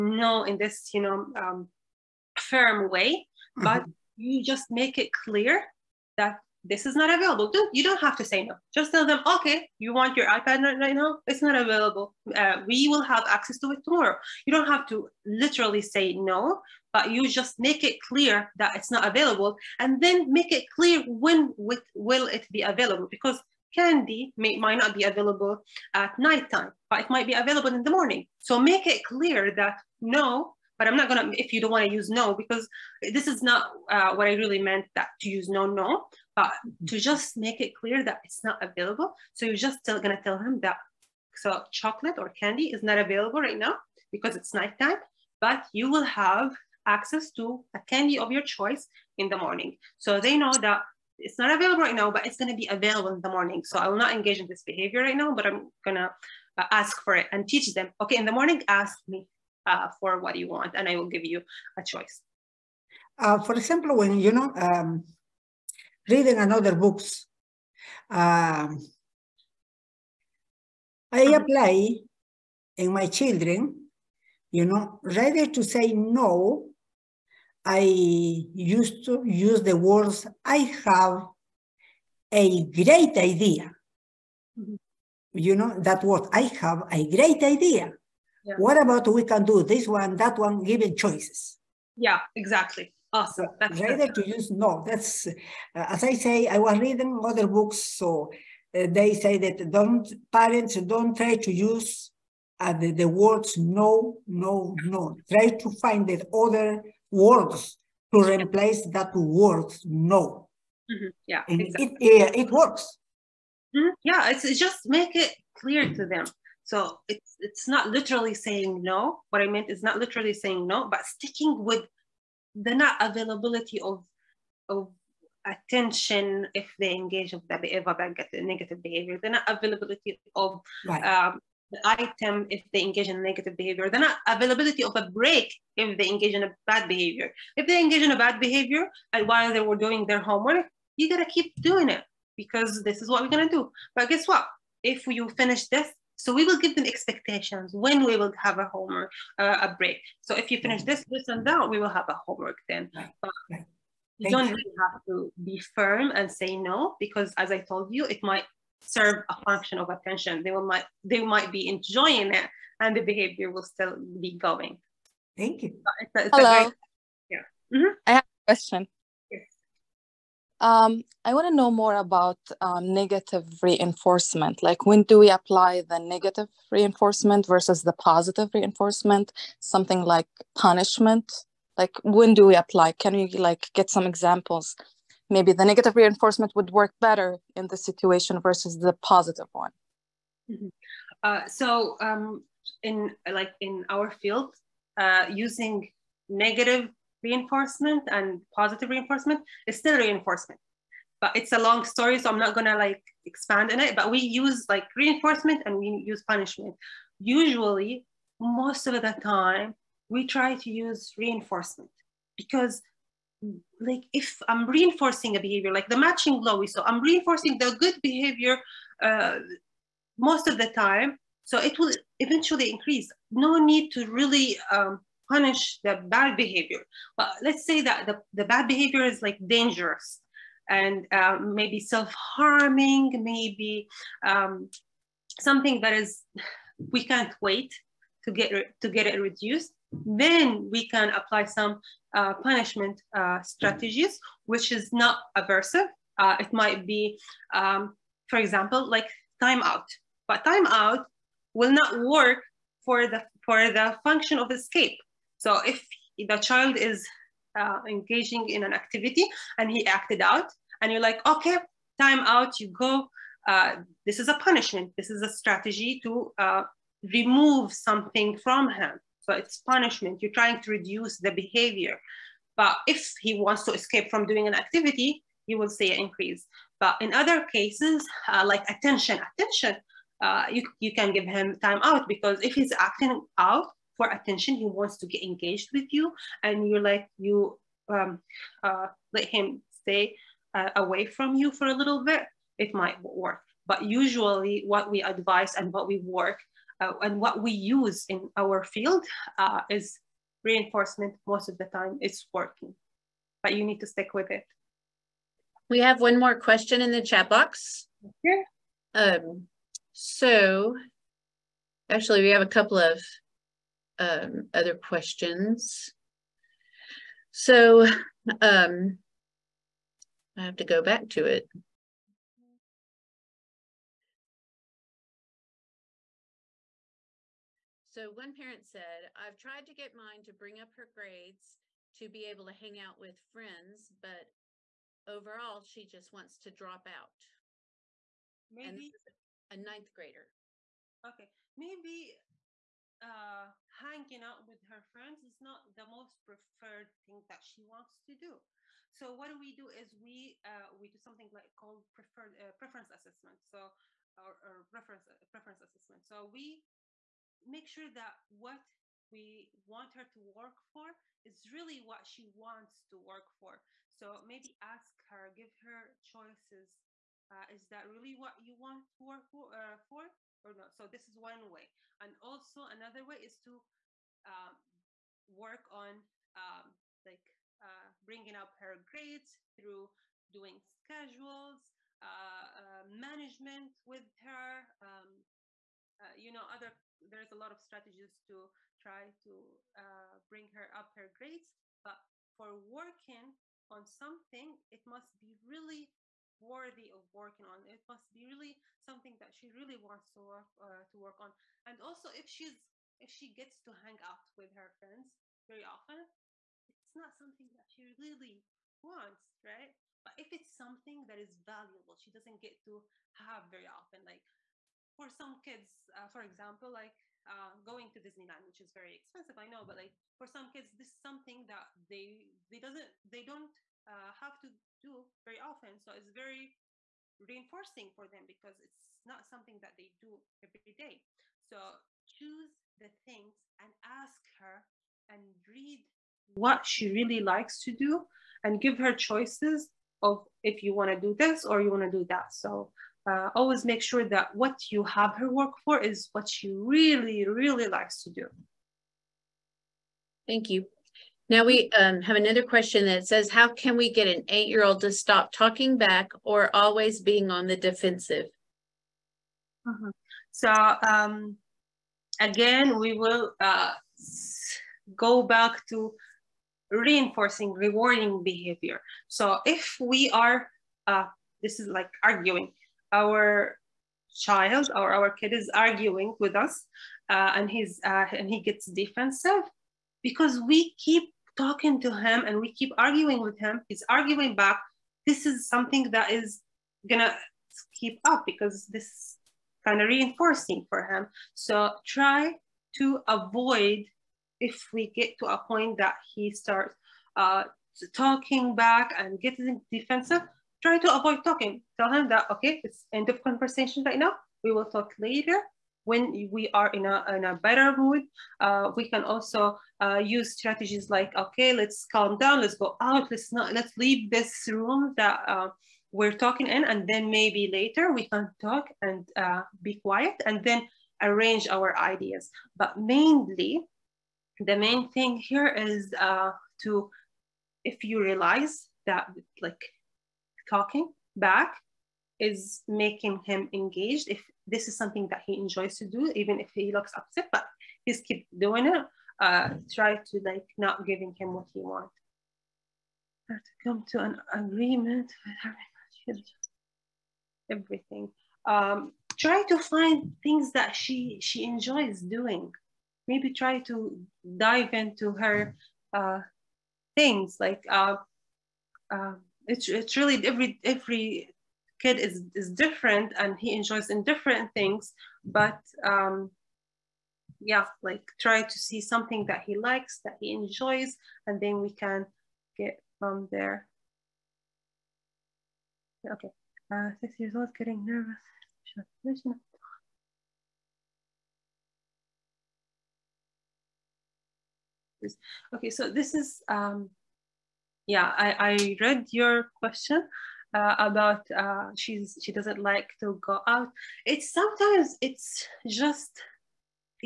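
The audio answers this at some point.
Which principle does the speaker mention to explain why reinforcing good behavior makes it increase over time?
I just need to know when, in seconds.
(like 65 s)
215 s.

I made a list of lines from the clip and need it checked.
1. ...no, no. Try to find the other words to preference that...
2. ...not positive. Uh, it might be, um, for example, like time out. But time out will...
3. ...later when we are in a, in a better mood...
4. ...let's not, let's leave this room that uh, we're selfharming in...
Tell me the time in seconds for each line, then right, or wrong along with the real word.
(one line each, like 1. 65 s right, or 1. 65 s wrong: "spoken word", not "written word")
1. 104 s wrong: "replace", not "preference"
2. 244 s wrong: "aversive", not "positive"
3. 504 s right
4. 513 s wrong: "talking", not "selfharming".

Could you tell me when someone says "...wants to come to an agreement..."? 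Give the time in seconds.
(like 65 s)
541 s.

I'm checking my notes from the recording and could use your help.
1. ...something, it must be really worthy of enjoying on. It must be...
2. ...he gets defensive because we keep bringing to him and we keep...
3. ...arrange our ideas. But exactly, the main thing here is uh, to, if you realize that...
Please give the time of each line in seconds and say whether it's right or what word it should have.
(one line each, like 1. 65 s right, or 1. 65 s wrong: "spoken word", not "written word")
1. 393 s wrong: "working", not "enjoying"
2. 478 s wrong: "talking", not "bringing"
3. 521 s wrong: "mainly", not "exactly".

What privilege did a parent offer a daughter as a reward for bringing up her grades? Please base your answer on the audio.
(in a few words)
hang out with friends.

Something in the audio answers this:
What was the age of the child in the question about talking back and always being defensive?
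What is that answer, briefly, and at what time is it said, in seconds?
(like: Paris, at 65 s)
8, at 454 s.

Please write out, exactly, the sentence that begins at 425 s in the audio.
So it's very reinforcing for them because it's not something that they do every day.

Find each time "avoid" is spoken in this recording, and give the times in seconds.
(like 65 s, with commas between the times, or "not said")
493 s, 500 s.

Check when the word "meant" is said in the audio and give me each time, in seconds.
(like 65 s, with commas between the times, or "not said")
34 s, 119 s.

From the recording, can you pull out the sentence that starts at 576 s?
Okay, uh, six years old, getting nervous.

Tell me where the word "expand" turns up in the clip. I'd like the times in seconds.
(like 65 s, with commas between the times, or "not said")
203 s.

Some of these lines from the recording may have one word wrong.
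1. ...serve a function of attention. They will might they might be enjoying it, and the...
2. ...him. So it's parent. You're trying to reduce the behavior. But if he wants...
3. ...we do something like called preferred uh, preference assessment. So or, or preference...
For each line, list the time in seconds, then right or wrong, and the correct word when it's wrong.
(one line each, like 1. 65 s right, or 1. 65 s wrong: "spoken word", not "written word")
1. 158 s right
2. 268 s wrong: "punishment", not "parent"
3. 350 s right.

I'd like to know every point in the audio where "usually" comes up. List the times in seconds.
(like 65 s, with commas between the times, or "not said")
207 s, 293 s.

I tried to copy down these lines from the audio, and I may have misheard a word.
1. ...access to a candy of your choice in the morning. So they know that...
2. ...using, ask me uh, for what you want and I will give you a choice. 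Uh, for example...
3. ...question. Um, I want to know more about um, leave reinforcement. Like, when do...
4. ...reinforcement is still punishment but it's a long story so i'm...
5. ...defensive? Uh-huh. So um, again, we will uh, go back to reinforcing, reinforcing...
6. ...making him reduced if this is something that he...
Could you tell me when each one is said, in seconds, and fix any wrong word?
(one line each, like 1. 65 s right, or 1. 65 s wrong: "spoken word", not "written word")
1. 46 s right
2. 58 s wrong: "morning", not "using"
3. 168 s wrong: "negative", not "leave"
4. 198 s wrong: "reinforcement", not "punishment"
5. 457 s wrong: "rewarding", not "reinforcing"
6. 532 s wrong: "engaged", not "reduced".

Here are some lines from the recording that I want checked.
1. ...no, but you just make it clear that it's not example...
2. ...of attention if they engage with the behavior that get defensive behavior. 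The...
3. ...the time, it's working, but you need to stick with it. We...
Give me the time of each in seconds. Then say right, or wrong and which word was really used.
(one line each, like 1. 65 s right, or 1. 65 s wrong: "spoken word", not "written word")
1. 16 s wrong: "available", not "example"
2. 124 s wrong: "negative", not "defensive"
3. 301 s right.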